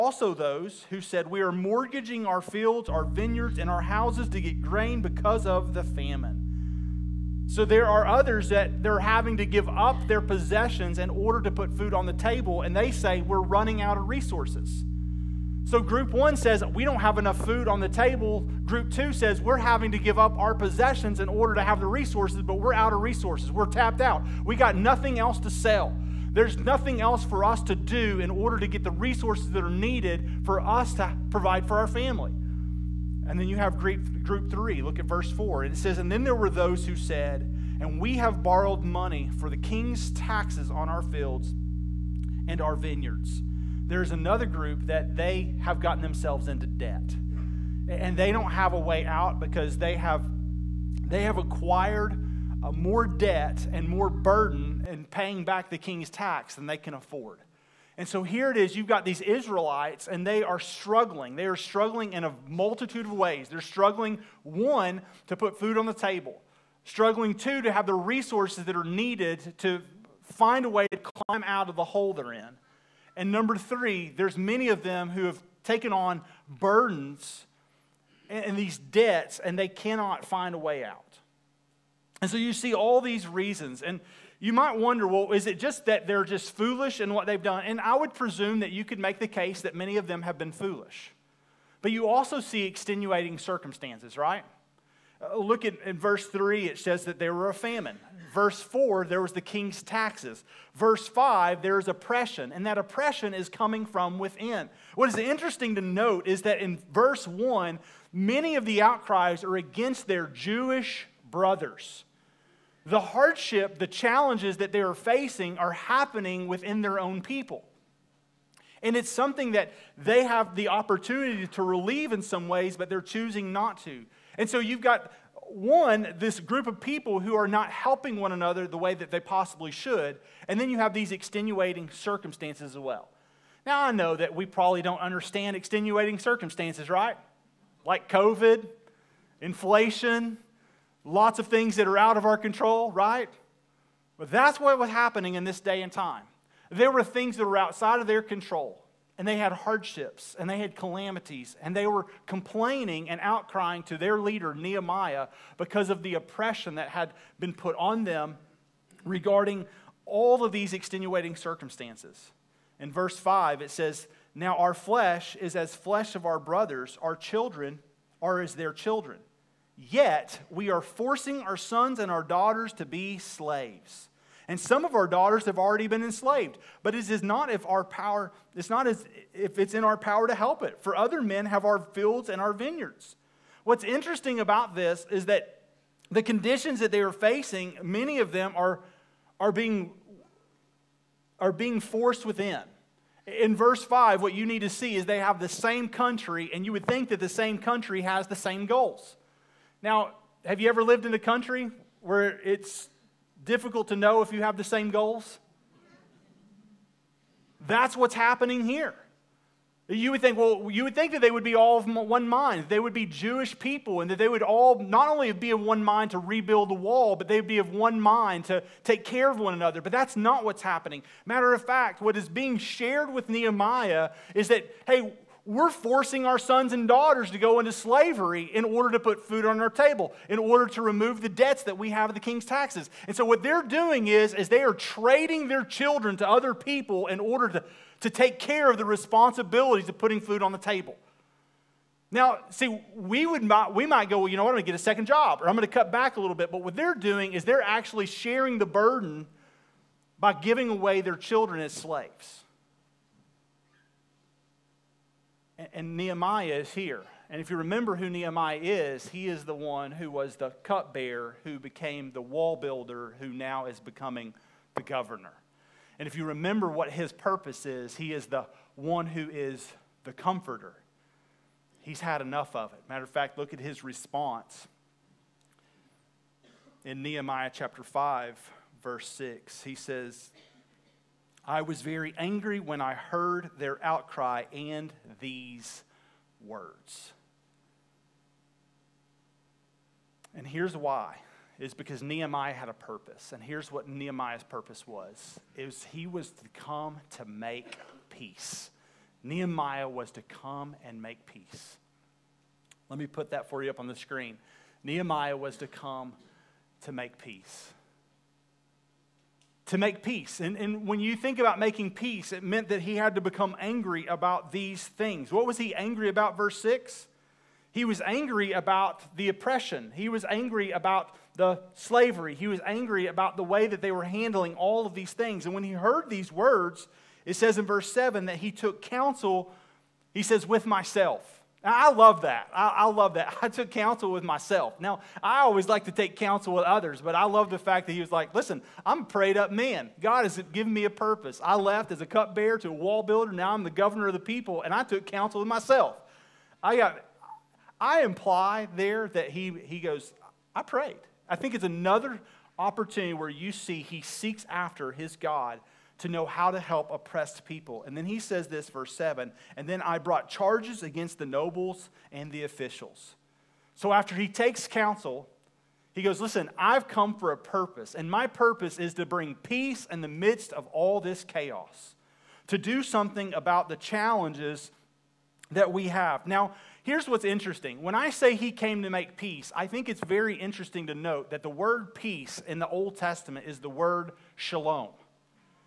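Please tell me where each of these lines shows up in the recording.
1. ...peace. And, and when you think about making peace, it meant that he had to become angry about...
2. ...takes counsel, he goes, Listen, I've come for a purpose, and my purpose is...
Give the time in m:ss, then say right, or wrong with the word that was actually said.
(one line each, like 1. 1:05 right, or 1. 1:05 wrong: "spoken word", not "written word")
1. 5:10 right
2. 6:04 right.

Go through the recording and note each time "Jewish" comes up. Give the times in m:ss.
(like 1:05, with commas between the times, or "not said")
1:50, 3:33.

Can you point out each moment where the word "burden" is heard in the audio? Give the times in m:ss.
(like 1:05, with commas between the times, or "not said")
0:54, 1:16, 4:08.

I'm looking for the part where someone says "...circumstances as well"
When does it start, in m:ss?
2:11.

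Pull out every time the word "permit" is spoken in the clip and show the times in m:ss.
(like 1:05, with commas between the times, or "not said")
not said.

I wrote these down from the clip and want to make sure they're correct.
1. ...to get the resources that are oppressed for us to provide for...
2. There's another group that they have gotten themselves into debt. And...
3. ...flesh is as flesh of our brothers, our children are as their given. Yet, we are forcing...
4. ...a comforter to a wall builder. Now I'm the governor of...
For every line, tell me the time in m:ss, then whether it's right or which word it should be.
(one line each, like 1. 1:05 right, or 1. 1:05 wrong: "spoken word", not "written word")
1. 0:28 wrong: "needed", not "oppressed"
2. 0:43 right
3. 2:44 wrong: "children", not "given"
4. 5:41 wrong: "cupbearer", not "comforter".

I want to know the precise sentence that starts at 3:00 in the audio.
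For other men have our fields and our vineyards.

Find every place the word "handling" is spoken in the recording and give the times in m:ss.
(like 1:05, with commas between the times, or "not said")
5:24.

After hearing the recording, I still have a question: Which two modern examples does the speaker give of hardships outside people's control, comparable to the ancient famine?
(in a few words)
COVID, inflation.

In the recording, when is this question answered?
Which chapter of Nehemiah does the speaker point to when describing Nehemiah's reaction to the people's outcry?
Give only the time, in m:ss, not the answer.
4:37.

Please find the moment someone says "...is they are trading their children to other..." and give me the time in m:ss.
3:54.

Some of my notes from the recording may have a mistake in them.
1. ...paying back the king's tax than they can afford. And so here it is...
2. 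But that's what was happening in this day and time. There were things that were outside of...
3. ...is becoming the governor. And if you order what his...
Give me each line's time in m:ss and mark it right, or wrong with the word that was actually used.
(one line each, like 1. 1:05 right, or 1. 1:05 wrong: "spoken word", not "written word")
1. 0:55 right
2. 2:24 right
3. 4:23 wrong: "remember", not "order".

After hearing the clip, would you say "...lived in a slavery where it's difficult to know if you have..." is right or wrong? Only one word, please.
wrong.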